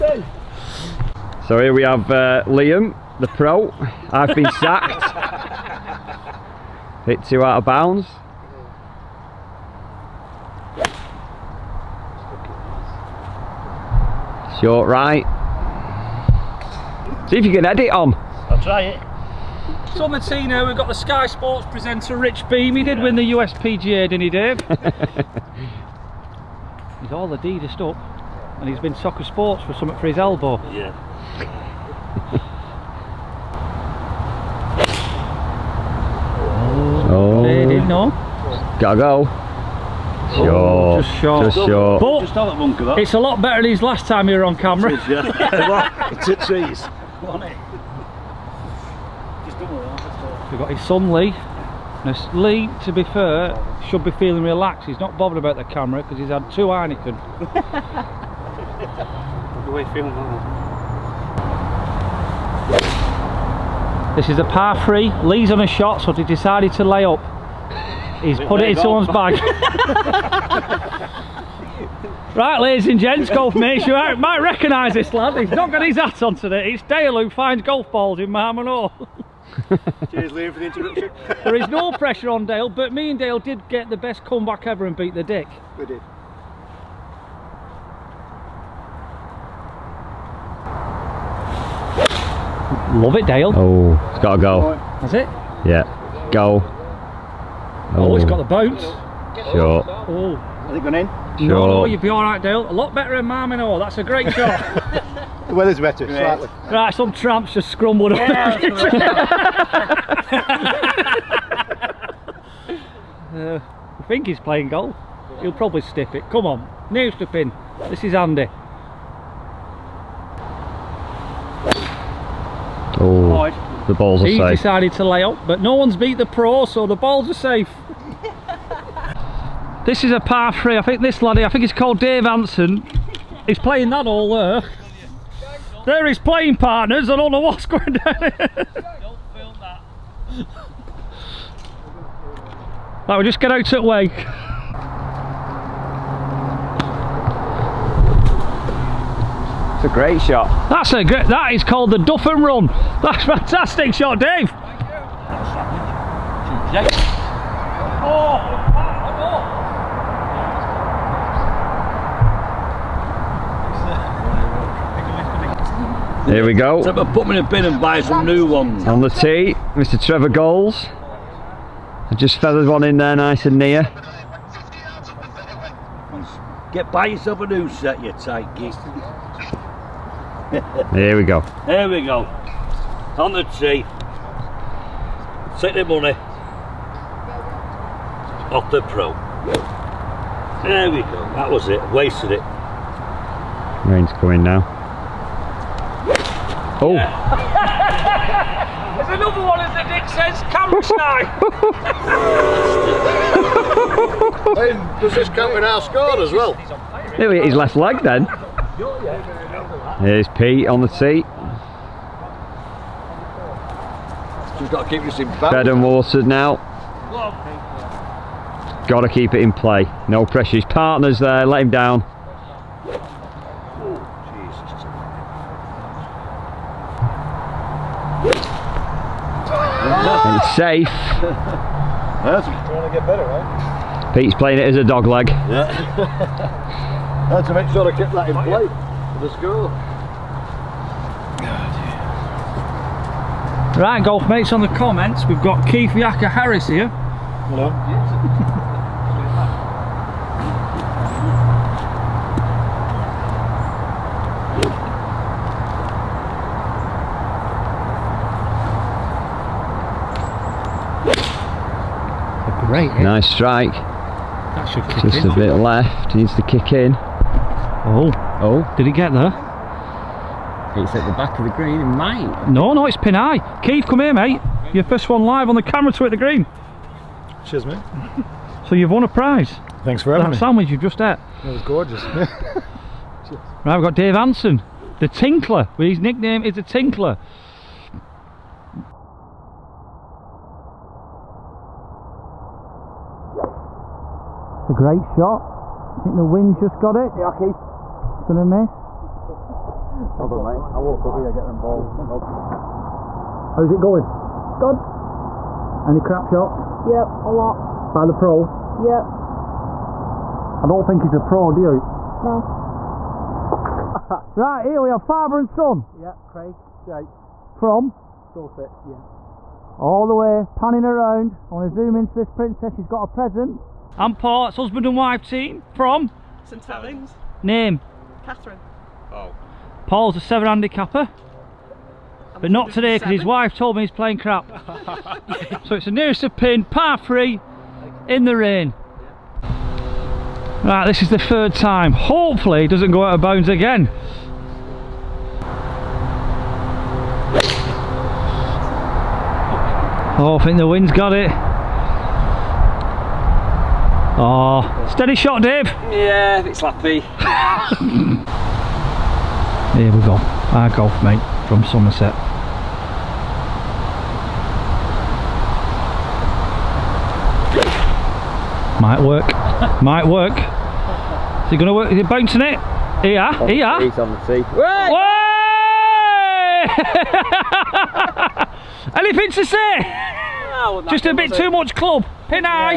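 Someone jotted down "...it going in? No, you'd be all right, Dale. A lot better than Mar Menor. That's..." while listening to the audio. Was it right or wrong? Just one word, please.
right.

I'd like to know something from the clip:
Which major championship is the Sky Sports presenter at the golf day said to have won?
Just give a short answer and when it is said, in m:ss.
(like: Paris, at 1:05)
USPGA, at 0:23.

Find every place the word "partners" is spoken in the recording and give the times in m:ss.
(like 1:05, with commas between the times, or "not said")
2:16, 3:40.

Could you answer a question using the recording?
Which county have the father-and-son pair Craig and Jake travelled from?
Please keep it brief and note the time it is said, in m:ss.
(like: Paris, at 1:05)
Dorset, at 5:18.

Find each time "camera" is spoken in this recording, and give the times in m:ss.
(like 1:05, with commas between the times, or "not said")
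0:44, 0:55, 4:35.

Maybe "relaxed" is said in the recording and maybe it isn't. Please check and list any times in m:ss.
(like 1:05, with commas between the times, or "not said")
0:54.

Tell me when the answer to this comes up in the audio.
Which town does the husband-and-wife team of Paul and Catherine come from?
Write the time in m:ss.
5:26.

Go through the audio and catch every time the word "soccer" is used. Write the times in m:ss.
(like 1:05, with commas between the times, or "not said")
0:28.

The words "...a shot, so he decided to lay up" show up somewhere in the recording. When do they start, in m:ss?
1:05.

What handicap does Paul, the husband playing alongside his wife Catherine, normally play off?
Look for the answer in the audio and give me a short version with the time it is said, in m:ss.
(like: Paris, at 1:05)
7, at 5:30.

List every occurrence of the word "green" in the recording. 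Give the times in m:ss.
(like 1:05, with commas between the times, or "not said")
4:31, 4:36.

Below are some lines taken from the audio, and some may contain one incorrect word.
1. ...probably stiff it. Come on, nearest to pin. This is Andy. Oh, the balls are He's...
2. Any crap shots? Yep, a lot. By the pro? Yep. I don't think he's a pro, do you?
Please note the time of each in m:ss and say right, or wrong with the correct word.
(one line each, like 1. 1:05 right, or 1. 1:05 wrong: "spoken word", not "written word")
1. 1:55 right
2. 5:05 right.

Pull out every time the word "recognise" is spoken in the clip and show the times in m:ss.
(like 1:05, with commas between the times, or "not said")
1:14.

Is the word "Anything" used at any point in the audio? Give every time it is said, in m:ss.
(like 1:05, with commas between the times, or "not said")
6:18.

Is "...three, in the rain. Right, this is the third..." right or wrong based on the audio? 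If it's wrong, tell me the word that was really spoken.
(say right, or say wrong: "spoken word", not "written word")
right.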